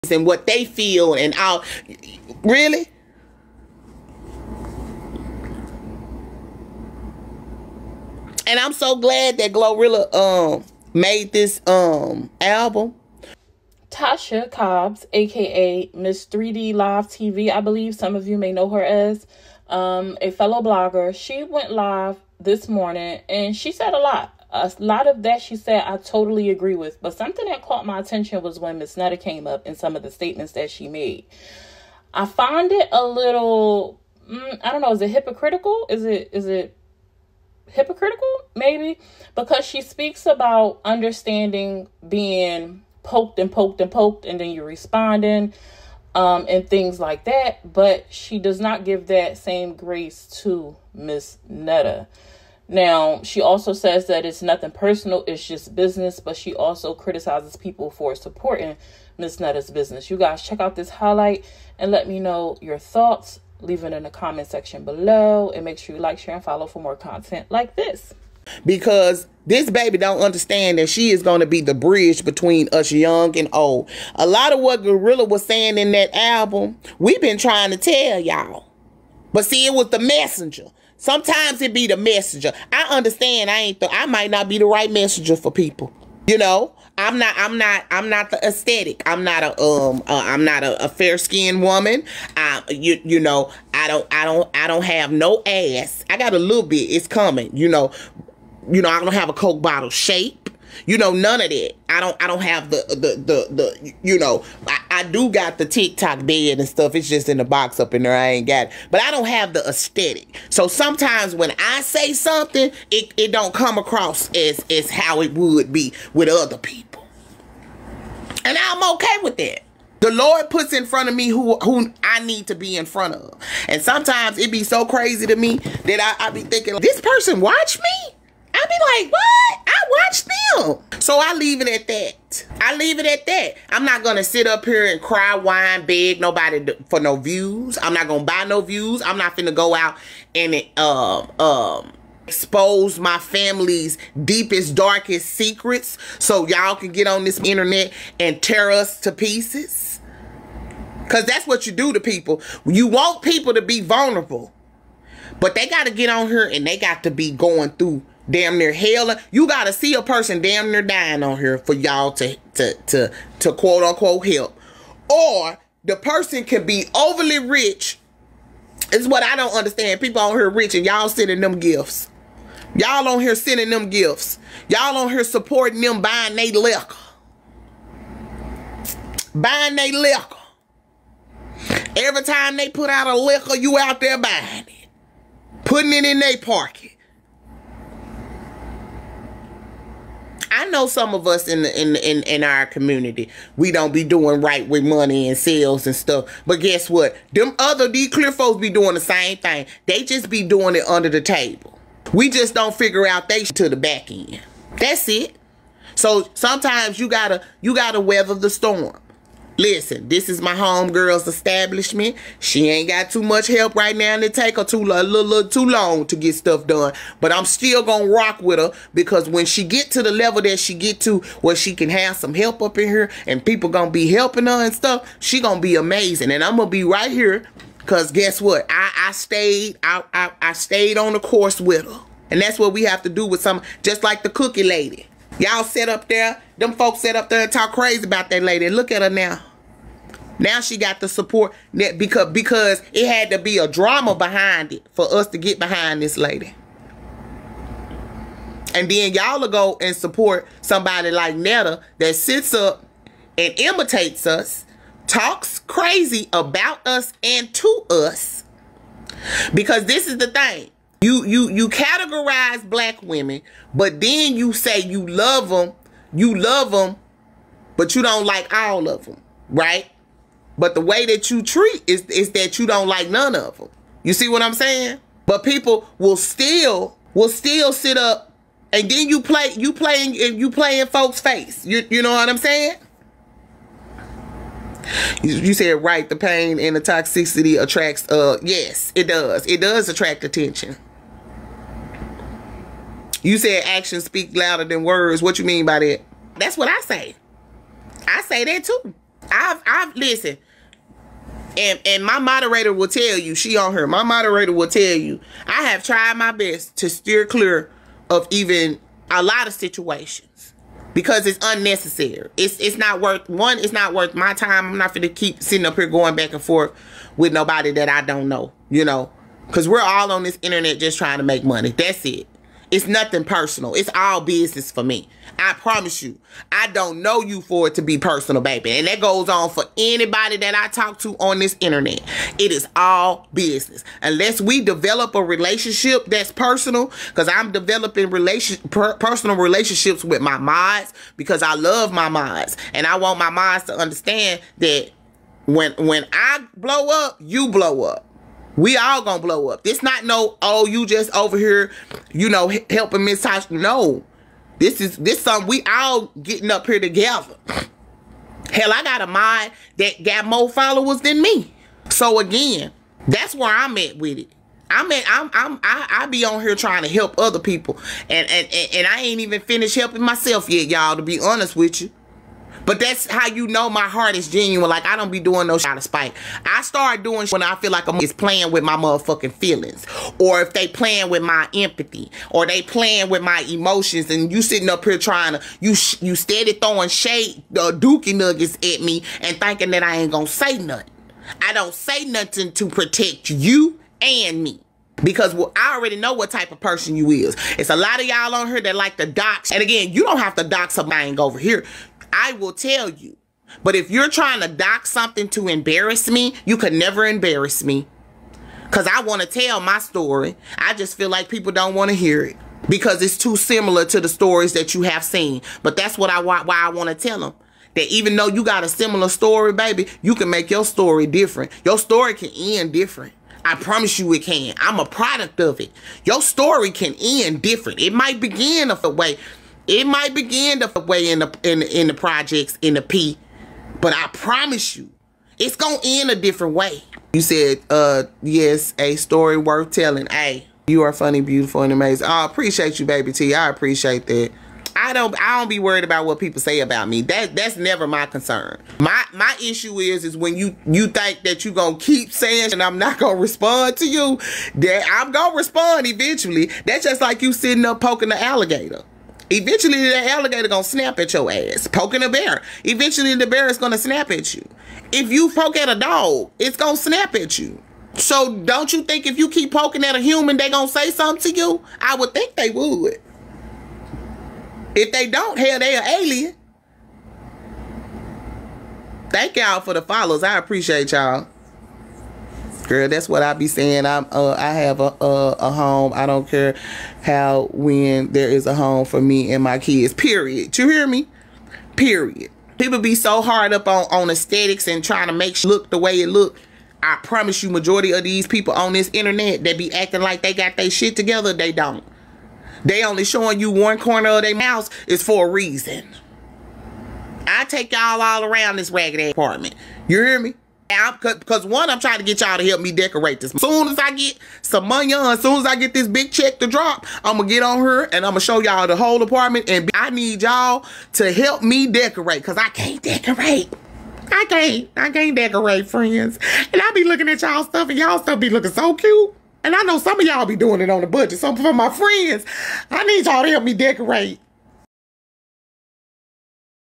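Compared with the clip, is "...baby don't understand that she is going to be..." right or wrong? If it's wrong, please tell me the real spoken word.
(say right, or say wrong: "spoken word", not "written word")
right.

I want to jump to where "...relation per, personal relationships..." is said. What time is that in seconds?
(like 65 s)
338 s.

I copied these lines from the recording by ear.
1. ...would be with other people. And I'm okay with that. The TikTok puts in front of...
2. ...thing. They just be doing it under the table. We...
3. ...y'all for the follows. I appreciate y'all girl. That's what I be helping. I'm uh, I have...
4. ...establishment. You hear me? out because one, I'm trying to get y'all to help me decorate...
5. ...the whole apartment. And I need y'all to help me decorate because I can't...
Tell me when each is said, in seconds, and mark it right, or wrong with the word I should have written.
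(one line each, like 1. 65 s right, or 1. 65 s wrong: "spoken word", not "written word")
1. 115 s wrong: "Lord", not "TikTok"
2. 199 s right
3. 479 s wrong: "saying", not "helping"
4. 509 s wrong: "apartment", not "establishment"
5. 518 s right.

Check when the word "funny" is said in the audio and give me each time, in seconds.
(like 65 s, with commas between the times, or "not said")
440 s.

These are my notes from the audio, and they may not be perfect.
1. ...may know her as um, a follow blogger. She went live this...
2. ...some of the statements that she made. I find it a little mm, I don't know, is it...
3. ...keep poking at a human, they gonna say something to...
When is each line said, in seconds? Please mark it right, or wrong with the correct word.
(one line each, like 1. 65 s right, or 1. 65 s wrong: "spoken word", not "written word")
1. 18 s wrong: "fellow", not "follow"
2. 29 s right
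3. 469 s right.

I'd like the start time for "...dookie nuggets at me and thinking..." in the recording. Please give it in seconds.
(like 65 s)
387 s.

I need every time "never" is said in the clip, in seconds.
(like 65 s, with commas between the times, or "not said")
406 s, 447 s.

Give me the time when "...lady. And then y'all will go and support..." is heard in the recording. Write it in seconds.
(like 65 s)
246 s.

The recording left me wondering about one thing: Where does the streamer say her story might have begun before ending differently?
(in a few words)
The projects.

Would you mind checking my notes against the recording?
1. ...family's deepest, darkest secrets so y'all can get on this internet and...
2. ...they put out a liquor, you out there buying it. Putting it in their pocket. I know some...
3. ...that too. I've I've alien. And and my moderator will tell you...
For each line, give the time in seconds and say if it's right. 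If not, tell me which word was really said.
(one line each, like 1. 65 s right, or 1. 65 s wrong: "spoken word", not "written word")
1. 143 s right
2. 182 s right
3. 298 s wrong: "listen", not "alien".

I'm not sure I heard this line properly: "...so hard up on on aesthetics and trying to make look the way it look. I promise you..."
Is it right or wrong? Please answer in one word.
right.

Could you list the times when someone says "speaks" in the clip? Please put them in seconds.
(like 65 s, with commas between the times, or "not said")
39 s, 294 s.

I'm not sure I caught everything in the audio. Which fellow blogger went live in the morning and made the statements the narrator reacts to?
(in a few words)
Tasha Cobbs.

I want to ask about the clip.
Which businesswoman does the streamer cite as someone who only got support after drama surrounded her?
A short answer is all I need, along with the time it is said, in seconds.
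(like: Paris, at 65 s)
The cookie lady, at 234 s.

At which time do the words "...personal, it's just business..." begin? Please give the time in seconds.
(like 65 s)
54 s.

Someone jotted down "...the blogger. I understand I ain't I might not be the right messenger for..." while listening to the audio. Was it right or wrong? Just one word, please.
wrong.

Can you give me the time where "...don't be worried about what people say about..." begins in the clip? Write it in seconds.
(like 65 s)
445 s.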